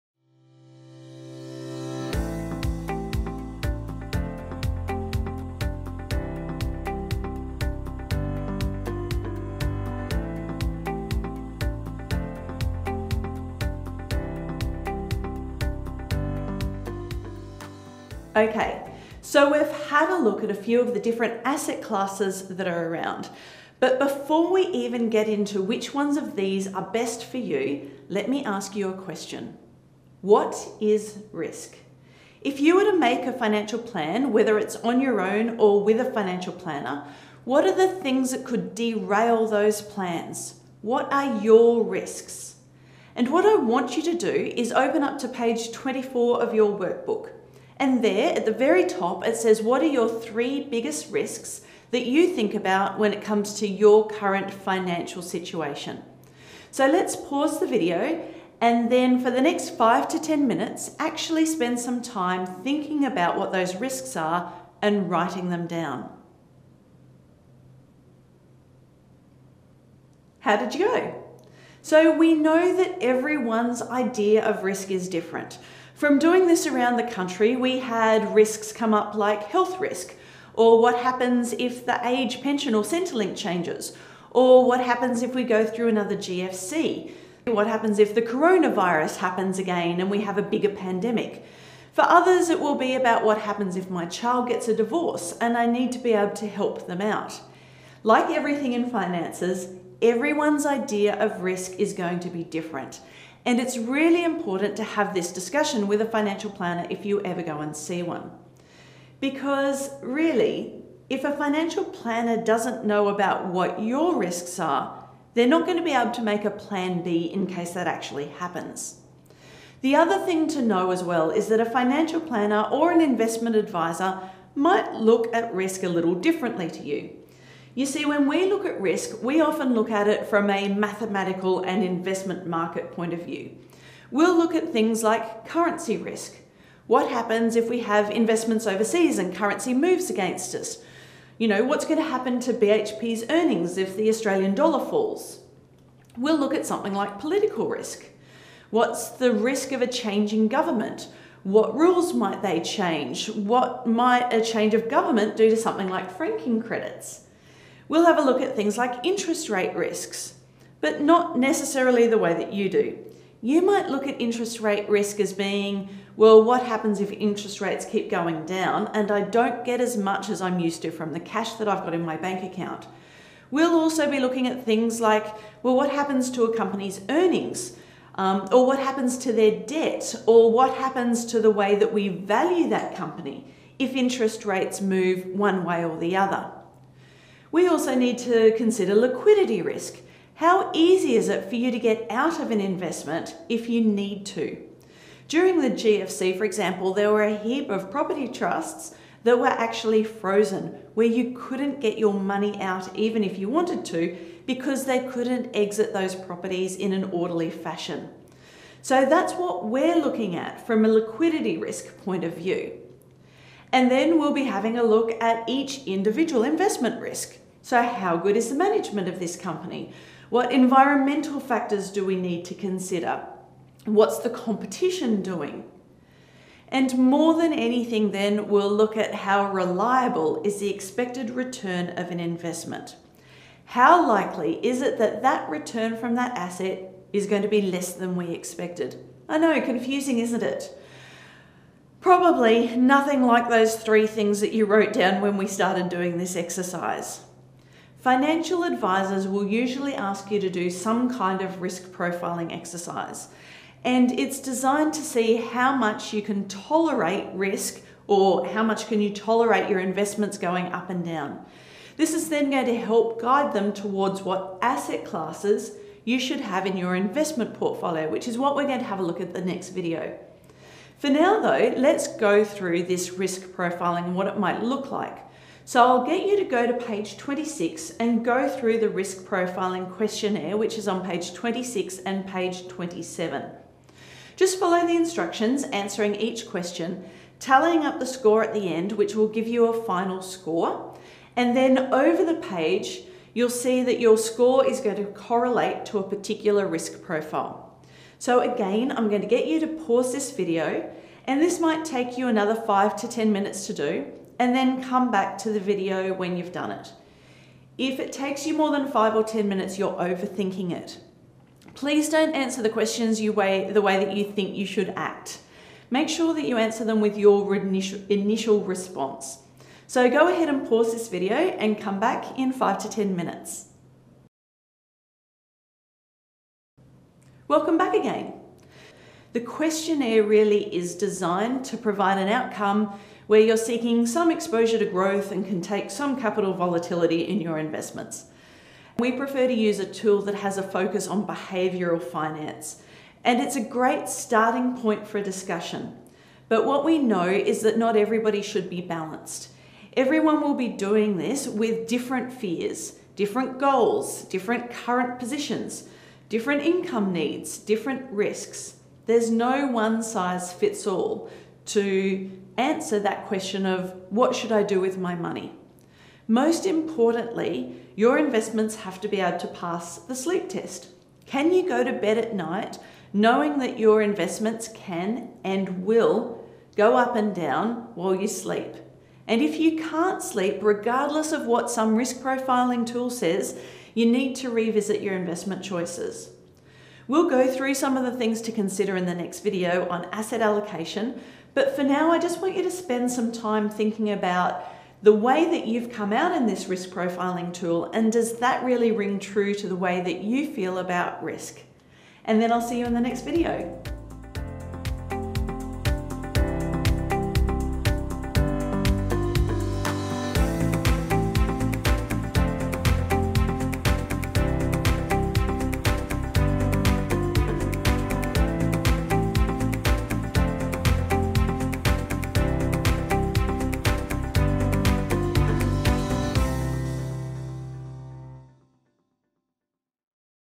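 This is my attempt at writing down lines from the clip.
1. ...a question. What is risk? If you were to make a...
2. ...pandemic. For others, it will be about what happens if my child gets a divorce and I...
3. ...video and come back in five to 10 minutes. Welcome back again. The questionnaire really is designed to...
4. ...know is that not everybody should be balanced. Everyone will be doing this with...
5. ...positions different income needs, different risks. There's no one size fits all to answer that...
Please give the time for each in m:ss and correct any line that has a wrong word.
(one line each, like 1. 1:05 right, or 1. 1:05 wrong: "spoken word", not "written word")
1. 0:28 right
2. 1:30 right
3. 5:21 right
4. 5:46 right
5. 5:55 right.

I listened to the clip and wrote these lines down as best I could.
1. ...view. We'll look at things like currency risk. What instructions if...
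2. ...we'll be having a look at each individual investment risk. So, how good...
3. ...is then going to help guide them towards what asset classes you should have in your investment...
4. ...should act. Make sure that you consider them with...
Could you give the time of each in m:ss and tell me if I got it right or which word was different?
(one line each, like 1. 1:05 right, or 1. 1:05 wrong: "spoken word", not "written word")
1. 2:13 wrong: "happens", not "instructions"
2. 3:34 right
3. 4:22 right
4. 5:14 wrong: "answer", not "consider".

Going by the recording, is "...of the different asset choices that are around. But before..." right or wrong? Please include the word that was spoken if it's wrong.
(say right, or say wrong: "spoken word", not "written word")
wrong: "classes", not "choices".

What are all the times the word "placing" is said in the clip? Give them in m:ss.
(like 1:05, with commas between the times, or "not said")
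not said.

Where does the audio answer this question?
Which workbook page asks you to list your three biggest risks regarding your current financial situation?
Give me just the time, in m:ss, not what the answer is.
0:45.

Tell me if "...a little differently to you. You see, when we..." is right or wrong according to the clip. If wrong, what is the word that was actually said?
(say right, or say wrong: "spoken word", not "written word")
right.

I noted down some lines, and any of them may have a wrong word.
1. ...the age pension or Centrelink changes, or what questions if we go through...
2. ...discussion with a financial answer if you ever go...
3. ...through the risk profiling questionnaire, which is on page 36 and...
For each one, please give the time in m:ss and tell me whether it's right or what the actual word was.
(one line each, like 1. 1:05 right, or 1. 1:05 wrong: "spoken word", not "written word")
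1. 1:21 wrong: "happens", not "questions"
2. 1:45 wrong: "planner", not "answer"
3. 4:38 wrong: "26", not "36".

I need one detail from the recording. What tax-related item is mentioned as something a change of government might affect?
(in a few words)
Franking credits.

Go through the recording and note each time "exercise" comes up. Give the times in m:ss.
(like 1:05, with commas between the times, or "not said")
4:06, 4:12.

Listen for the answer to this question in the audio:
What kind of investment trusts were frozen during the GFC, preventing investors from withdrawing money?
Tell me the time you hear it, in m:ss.
3:17.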